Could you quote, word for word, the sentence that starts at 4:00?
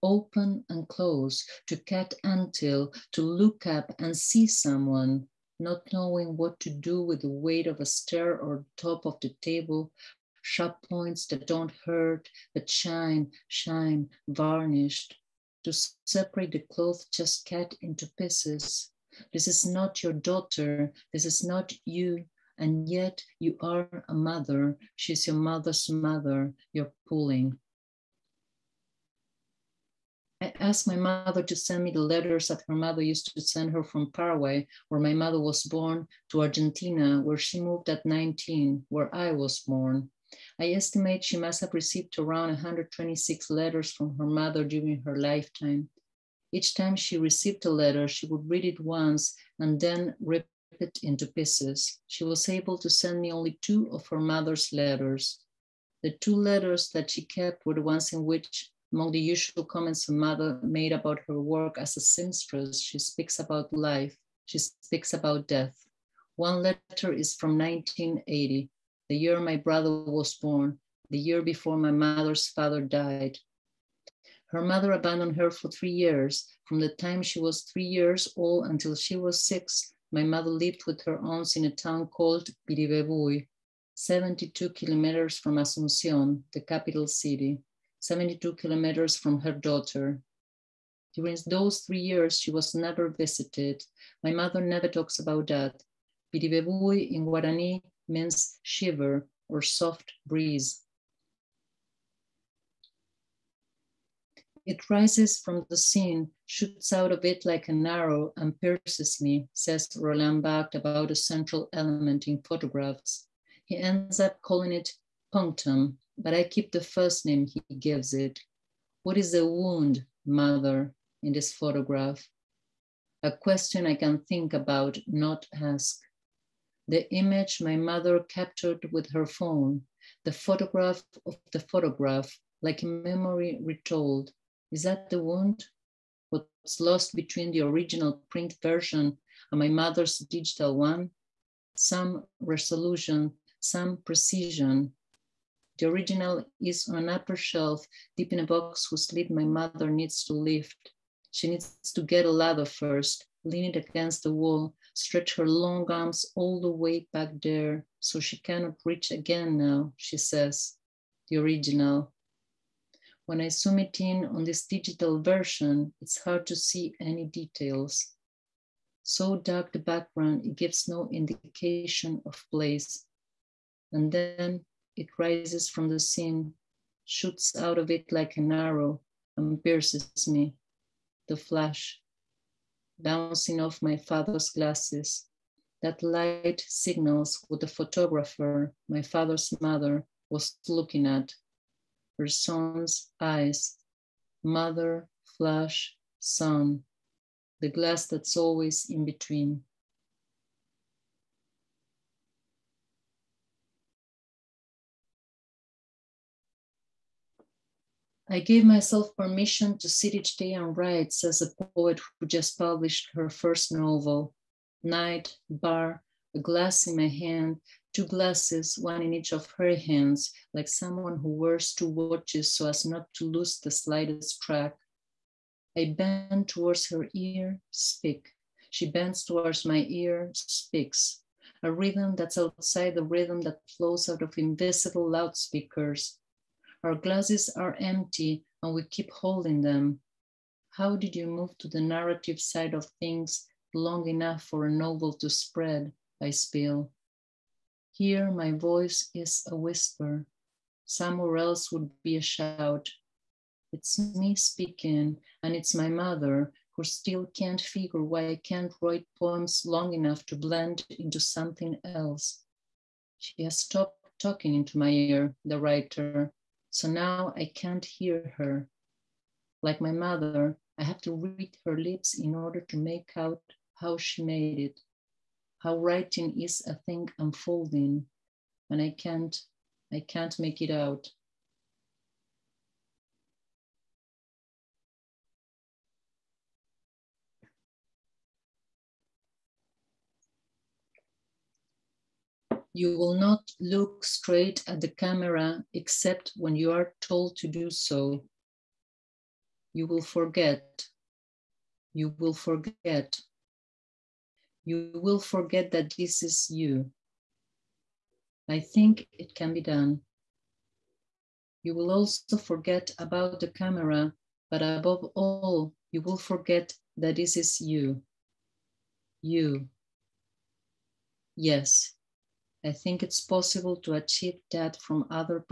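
How did you move to the narrative side of things long enough for a novel to spread?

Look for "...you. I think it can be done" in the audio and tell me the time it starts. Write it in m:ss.
5:06.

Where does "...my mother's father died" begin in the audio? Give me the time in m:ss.
1:11.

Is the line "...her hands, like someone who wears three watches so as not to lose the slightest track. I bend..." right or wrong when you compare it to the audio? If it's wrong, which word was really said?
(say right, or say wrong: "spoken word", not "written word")
wrong: "two", not "three".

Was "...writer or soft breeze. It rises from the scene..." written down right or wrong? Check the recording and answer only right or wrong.
wrong.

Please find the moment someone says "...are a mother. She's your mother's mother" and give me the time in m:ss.
0:23.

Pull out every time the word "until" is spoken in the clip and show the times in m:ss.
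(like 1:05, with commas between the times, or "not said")
0:02, 1:18.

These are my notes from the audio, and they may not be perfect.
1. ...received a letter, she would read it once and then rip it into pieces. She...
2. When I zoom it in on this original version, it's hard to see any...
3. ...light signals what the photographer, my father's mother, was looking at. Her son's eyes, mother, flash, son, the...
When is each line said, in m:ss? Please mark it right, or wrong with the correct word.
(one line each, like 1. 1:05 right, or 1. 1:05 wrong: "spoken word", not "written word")
1. 0:47 right
2. 2:43 wrong: "digital", not "original"
3. 3:06 right.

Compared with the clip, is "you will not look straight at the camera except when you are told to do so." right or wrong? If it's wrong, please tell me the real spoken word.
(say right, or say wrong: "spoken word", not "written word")
right.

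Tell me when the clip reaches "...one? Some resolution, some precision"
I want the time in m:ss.
2:20.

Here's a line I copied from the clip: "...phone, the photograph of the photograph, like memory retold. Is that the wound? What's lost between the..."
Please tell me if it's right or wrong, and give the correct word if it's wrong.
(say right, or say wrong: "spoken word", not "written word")
right.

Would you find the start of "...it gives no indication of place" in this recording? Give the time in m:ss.
2:50.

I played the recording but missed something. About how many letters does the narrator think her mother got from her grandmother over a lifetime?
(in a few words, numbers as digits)
126.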